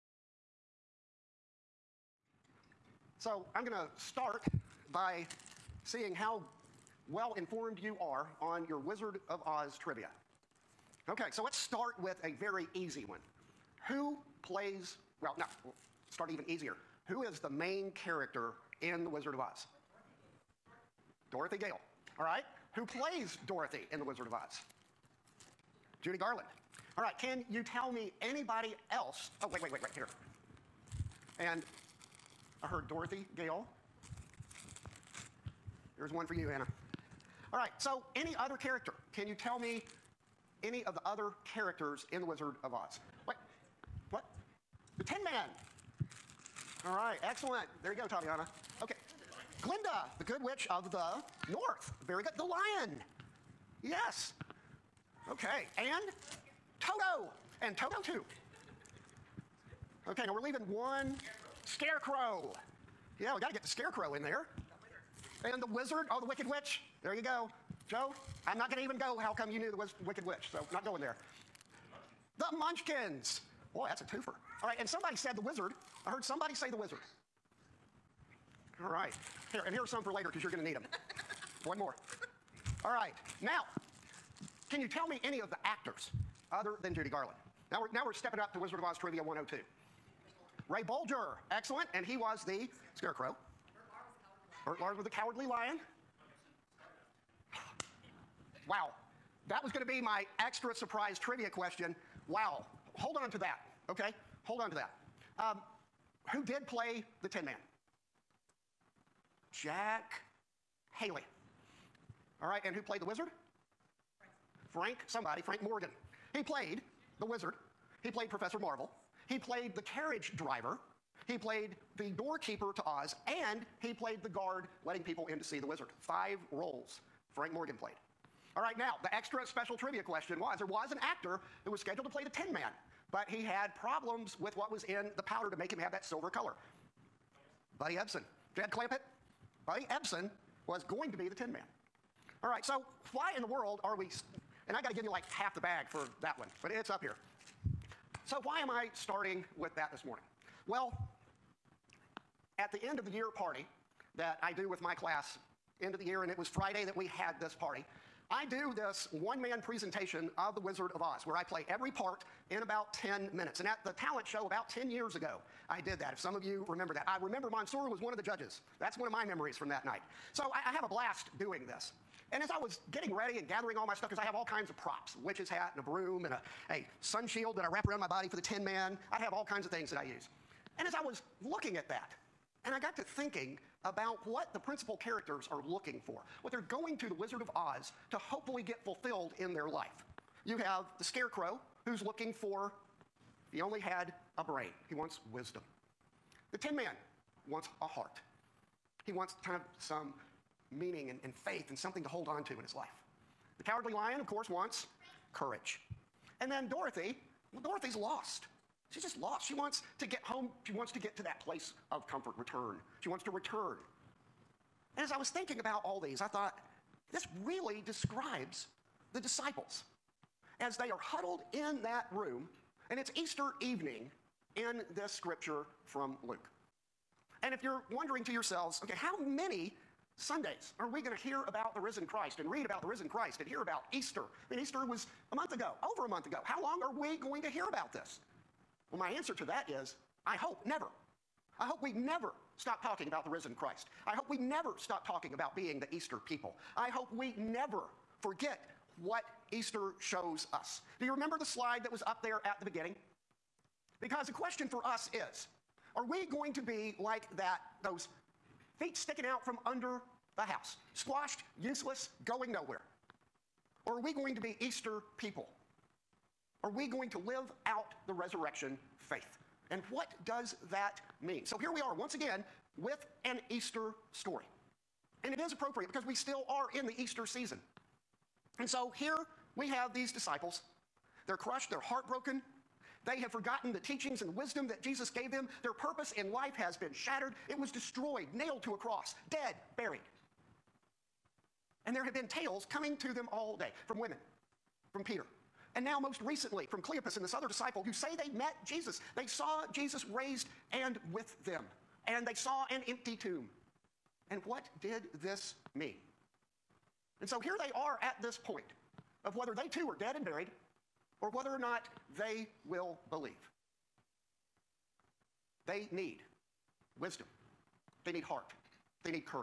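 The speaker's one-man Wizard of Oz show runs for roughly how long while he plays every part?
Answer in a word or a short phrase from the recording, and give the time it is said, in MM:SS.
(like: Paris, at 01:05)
10 minutes, at 02:42.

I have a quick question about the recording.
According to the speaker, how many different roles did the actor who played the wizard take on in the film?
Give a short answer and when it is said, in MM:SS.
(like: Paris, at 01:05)
5, at 02:05.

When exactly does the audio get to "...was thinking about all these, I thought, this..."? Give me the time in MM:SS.
03:35.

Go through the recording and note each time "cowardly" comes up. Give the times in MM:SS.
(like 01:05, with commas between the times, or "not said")
01:35, 03:23.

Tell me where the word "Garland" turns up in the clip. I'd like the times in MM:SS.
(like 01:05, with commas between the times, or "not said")
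00:26, 01:27.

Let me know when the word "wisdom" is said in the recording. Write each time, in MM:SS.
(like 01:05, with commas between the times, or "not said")
03:15, 04:44, 05:16.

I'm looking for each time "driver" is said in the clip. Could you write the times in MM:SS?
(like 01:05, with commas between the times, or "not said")
02:00.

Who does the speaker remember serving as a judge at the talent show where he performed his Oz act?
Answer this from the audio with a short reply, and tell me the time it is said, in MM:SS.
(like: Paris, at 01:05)
Mansoor, at 02:47.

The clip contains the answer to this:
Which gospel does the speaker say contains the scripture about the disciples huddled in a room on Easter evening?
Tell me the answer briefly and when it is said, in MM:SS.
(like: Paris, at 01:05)
Luke, at 03:46.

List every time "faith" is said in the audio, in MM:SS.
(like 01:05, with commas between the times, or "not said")
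03:21, 04:28.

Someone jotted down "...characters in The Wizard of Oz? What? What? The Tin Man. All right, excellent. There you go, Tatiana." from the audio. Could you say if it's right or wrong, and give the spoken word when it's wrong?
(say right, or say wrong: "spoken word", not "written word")
right.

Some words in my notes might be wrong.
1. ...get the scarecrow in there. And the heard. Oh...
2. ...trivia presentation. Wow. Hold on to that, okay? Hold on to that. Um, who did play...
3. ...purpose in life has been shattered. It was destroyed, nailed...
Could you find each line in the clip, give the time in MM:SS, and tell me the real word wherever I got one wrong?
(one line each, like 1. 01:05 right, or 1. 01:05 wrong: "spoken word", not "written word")
1. 01:03 wrong: "wizard", not "heard"
2. 01:41 wrong: "question", not "presentation"
3. 04:45 right.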